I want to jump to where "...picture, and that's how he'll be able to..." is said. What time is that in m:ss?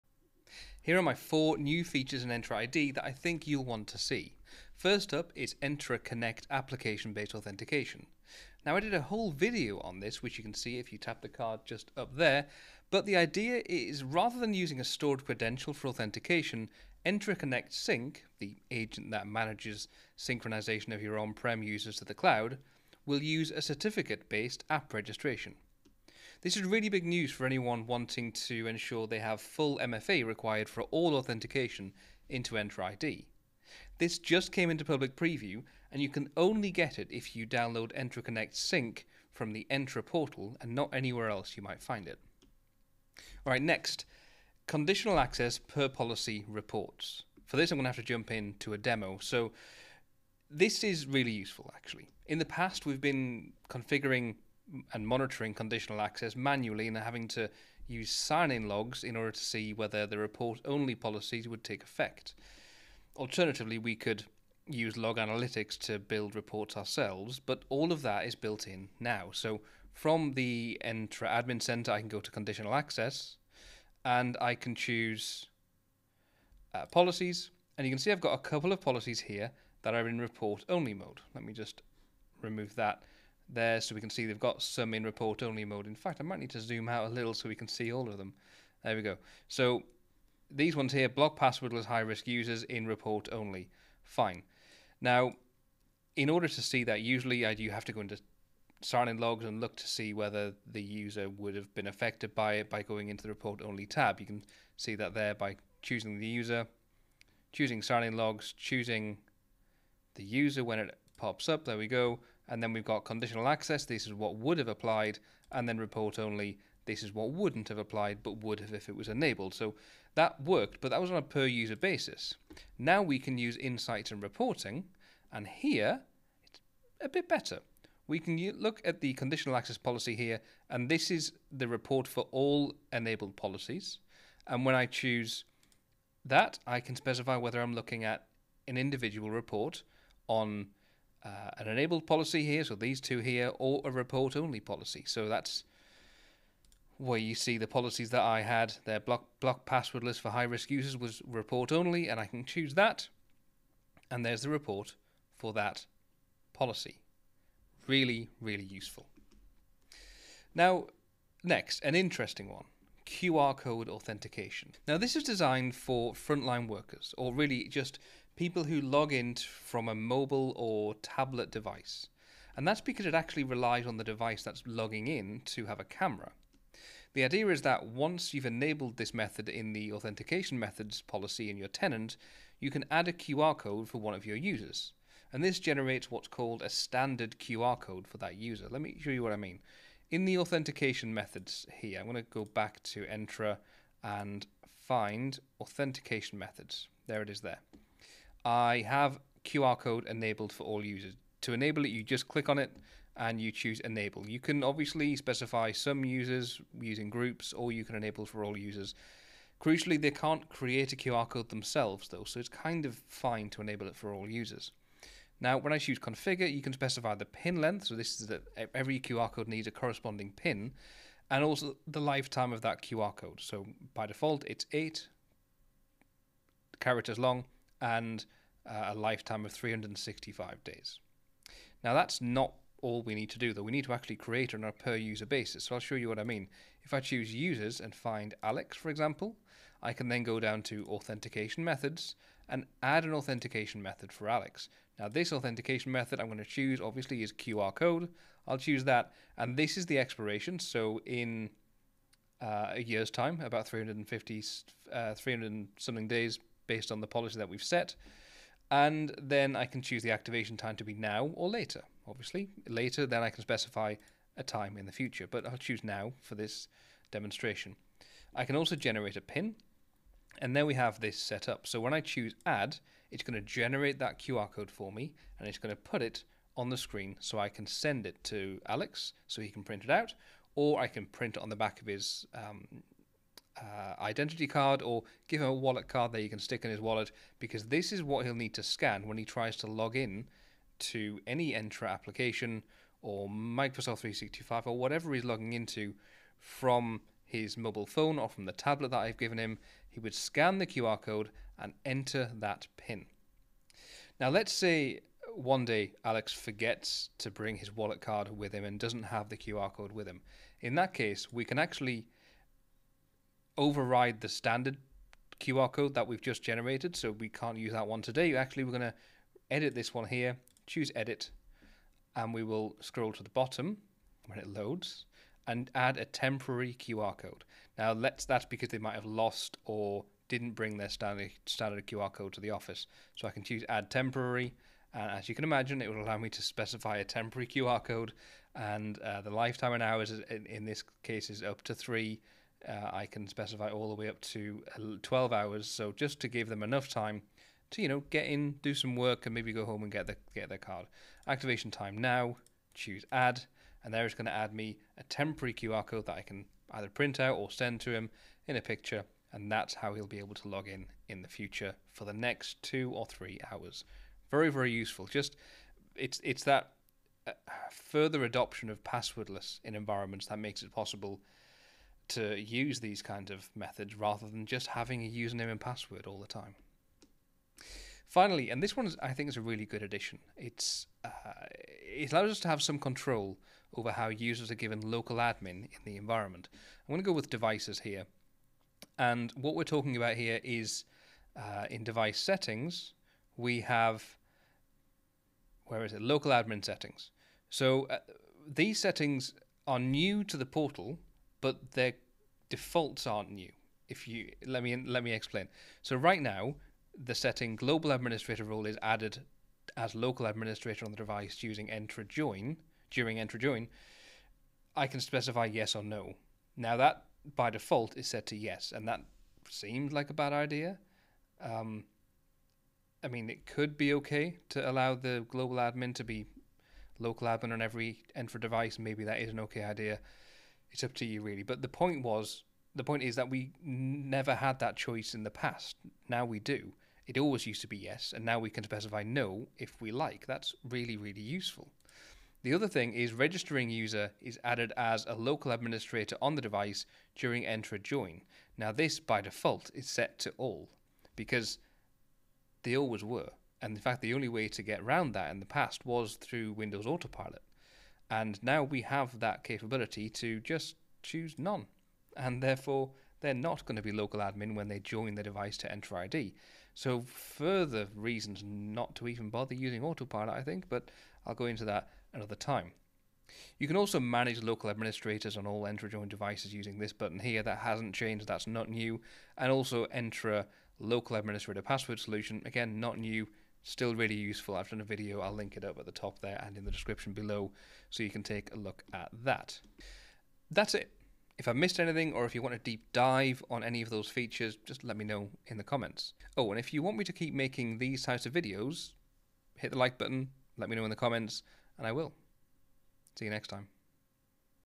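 5:58.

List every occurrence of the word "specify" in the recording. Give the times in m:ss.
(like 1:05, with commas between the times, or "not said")
2:16, 3:25, 3:36, 4:23, 5:36, 5:43, 6:55, 7:18.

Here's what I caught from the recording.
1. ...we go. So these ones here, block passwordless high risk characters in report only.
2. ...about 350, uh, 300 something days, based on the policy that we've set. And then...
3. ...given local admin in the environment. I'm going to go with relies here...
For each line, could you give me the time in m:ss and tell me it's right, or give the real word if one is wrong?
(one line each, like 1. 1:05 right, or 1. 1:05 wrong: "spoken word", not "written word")
1. 1:28 wrong: "users", not "characters"
2. 4:13 right
3. 6:24 wrong: "devices", not "relies".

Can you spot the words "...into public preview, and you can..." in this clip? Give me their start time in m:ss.
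0:34.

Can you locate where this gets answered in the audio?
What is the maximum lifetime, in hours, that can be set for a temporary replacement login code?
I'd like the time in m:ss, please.
5:45.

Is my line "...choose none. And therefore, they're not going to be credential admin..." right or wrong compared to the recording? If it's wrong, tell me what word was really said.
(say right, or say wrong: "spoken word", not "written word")
wrong: "local", not "credential".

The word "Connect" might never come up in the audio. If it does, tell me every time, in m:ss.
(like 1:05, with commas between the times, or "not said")
0:06, 0:17, 0:38.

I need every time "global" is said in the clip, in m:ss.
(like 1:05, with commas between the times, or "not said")
6:47, 7:05.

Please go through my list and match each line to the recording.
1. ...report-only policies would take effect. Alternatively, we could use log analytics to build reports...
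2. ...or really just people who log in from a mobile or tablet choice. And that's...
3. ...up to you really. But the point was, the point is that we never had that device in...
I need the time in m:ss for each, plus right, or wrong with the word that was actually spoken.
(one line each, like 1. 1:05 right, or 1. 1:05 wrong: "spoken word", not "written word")
1. 1:00 right
2. 2:47 wrong: "device", not "choice"
3. 7:10 wrong: "choice", not "device".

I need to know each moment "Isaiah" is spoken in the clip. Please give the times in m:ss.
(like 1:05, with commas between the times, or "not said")
not said.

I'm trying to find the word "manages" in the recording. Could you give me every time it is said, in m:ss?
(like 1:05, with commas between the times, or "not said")
0:19, 7:54.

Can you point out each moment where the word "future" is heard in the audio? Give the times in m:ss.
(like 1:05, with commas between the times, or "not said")
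4:24, 6:01.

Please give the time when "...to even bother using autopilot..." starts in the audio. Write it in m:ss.
7:48.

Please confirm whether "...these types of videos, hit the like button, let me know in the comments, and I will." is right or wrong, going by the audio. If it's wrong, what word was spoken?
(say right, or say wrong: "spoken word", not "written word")
right.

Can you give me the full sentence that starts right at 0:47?
For this, I'm going to have to jump into a demo.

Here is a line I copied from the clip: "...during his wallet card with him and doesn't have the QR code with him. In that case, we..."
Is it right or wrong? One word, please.
wrong.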